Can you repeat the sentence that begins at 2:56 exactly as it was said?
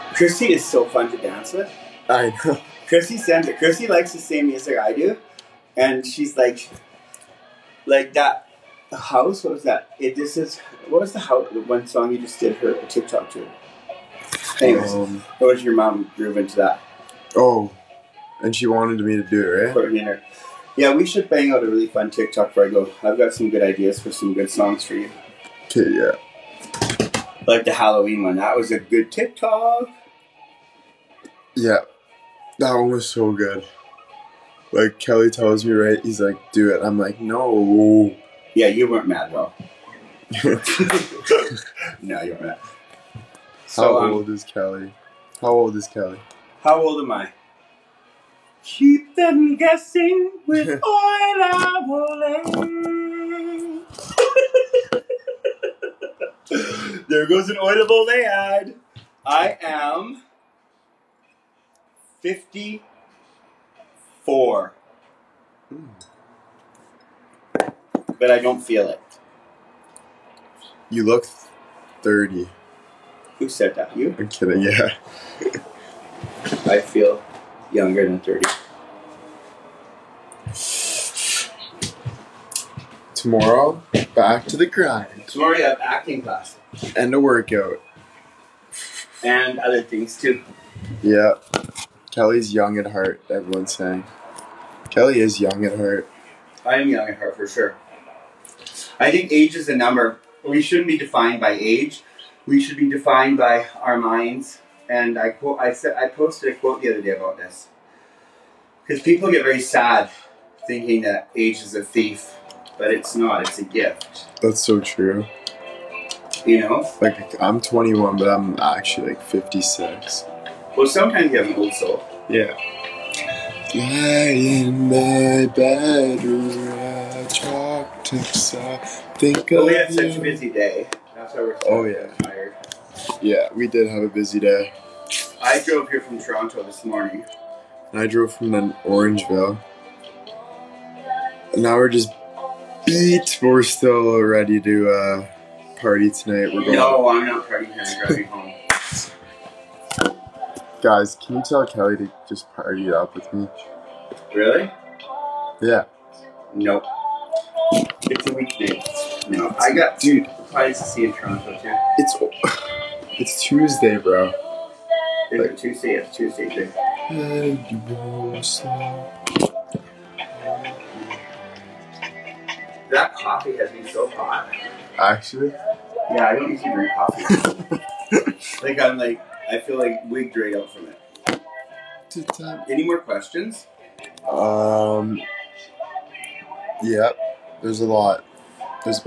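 Yeah, I don't usually drink coffee.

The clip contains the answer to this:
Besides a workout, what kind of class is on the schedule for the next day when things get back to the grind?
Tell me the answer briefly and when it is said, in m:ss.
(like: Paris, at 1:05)
Acting class, at 1:25.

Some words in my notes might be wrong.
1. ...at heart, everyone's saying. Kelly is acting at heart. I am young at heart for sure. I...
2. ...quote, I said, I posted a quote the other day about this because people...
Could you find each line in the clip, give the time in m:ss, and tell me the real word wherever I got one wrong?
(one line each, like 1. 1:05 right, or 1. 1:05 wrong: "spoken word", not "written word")
1. 1:32 wrong: "young", not "acting"
2. 1:45 right.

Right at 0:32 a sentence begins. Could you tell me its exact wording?
That one was so good like Kelly tells me, right?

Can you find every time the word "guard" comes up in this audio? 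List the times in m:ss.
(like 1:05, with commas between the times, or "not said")
not said.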